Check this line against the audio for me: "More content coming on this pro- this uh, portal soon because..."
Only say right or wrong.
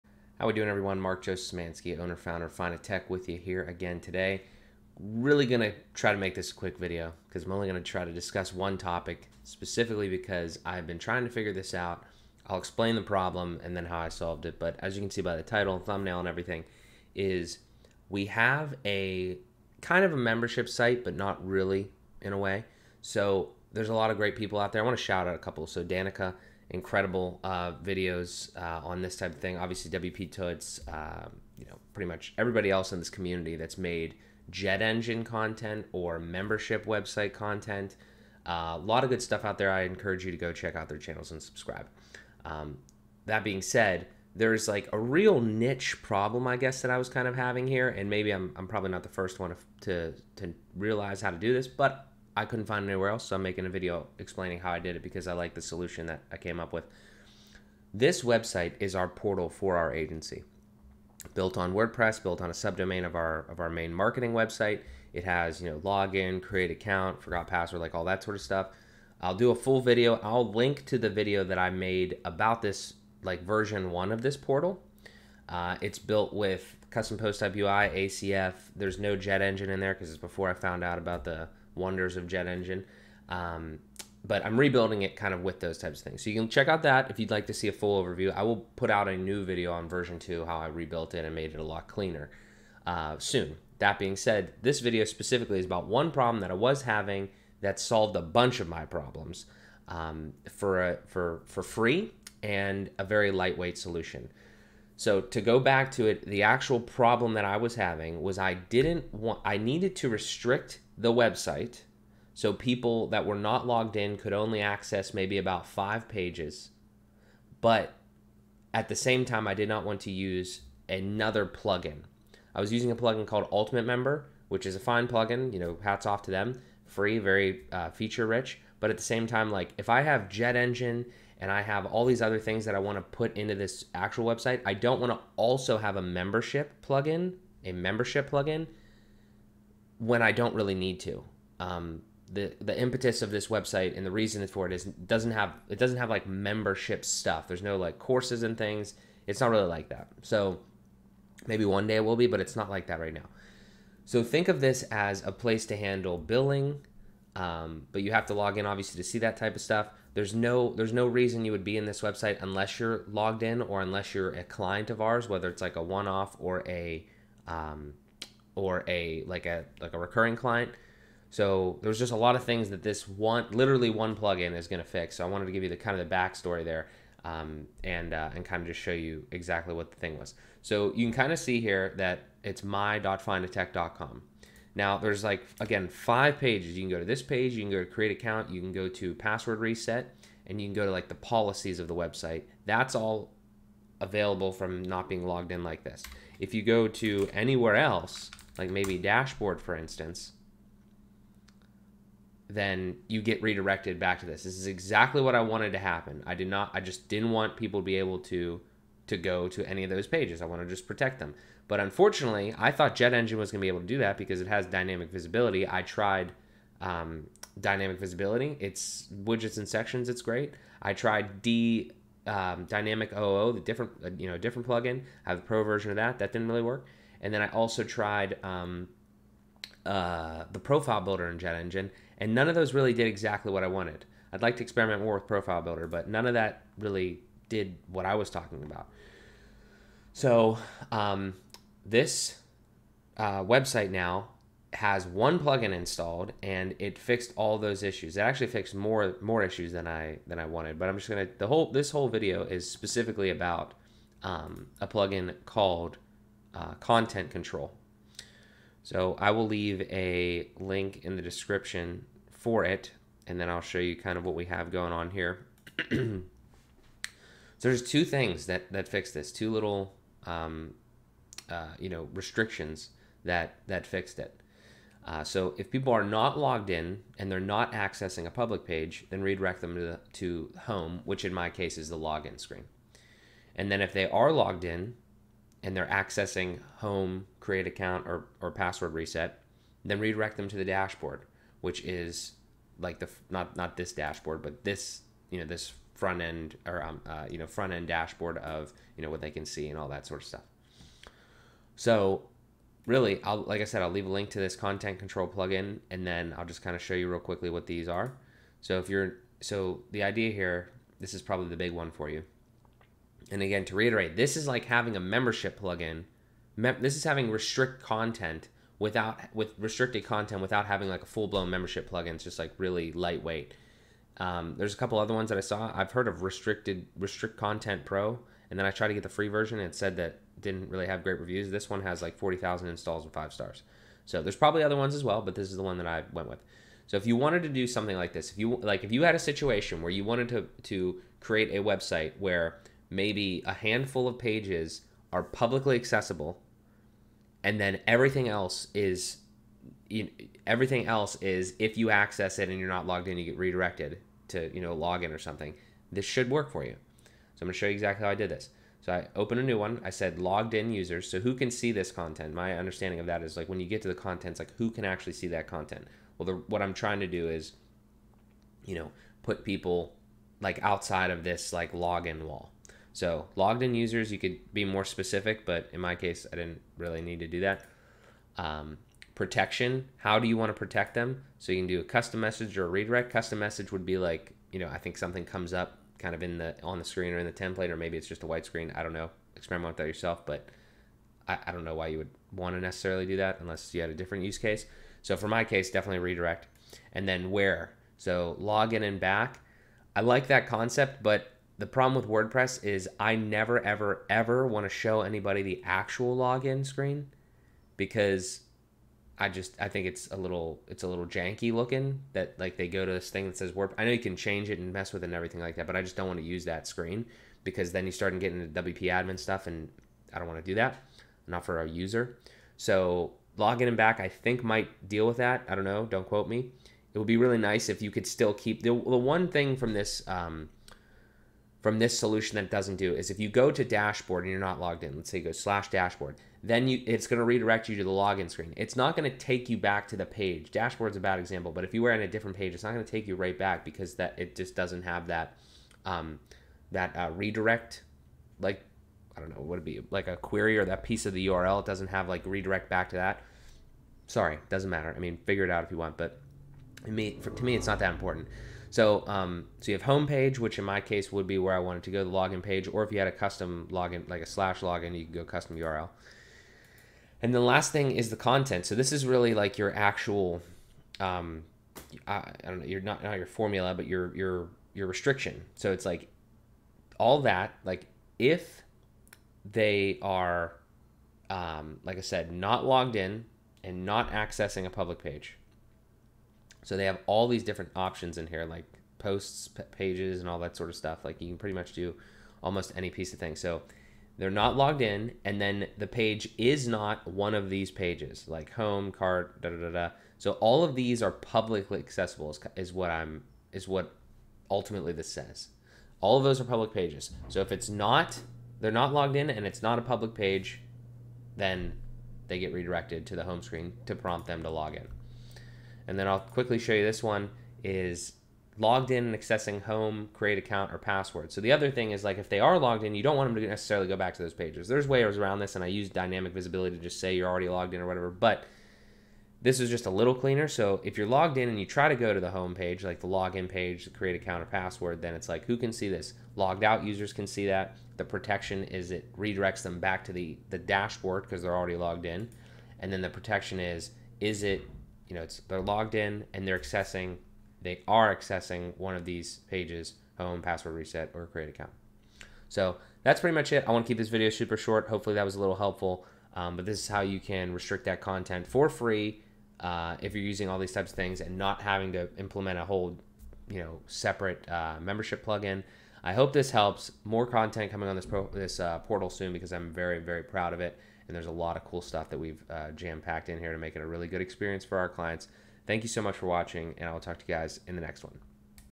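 right.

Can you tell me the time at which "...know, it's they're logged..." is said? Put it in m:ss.
9:05.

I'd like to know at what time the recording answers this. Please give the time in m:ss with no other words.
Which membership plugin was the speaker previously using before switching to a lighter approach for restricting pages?
2:03.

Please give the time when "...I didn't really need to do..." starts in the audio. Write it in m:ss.
6:16.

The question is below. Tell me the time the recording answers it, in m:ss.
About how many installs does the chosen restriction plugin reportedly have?
5:32.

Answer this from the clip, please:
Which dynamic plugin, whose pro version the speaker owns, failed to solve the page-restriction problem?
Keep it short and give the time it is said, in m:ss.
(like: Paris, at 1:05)
Dynamic OO, at 3:42.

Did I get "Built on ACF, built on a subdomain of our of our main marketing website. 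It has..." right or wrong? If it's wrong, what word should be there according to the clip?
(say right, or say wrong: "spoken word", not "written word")
wrong: "WordPress", not "ACF".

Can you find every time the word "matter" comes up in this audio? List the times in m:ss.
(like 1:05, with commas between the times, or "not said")
7:34.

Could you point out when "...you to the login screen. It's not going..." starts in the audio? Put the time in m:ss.
7:17.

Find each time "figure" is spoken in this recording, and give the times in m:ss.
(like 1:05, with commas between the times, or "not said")
0:11, 7:35.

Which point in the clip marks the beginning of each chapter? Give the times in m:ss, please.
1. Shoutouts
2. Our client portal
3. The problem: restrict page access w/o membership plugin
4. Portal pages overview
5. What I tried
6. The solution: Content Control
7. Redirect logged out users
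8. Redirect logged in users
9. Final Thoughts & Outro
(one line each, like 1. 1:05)
1. 0:24
2. 0:42
3. 1:35
4. 3:00
5. 3:25
6. 4:00
7. 5:05
8. 8:35
9. 9:13.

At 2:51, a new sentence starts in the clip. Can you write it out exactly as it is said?
So there's just a lot of things that this one literally one plugin is going to fix.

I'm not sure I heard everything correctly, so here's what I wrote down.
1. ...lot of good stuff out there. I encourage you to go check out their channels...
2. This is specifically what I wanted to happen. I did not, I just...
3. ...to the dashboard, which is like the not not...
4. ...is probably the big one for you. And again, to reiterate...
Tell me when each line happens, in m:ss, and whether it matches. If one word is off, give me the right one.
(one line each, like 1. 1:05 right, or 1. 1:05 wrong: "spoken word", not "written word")
1. 0:38 right
2. 3:24 wrong: "exactly", not "specifically"
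3. 4:50 right
4. 5:11 right.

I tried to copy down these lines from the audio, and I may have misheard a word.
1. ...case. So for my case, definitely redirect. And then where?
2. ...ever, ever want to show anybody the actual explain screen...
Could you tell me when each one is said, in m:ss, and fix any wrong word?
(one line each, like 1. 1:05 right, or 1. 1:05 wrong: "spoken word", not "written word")
1. 6:34 right
2. 6:43 wrong: "login", not "explain".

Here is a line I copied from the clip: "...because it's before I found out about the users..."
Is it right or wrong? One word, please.
wrong.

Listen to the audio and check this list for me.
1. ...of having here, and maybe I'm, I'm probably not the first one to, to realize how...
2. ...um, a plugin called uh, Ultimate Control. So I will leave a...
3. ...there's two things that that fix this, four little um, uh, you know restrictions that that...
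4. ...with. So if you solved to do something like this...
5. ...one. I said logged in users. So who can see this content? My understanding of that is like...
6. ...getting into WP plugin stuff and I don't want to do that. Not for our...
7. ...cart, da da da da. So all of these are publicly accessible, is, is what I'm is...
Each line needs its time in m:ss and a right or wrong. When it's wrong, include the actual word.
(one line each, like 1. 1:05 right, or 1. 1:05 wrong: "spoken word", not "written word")
1. 0:47 right
2. 4:14 wrong: "Content", not "Ultimate"
3. 4:27 wrong: "two", not "four"
4. 5:36 wrong: "wanted", not "solved"
5. 5:59 right
6. 6:58 wrong: "admin", not "plugin"
7. 8:18 right.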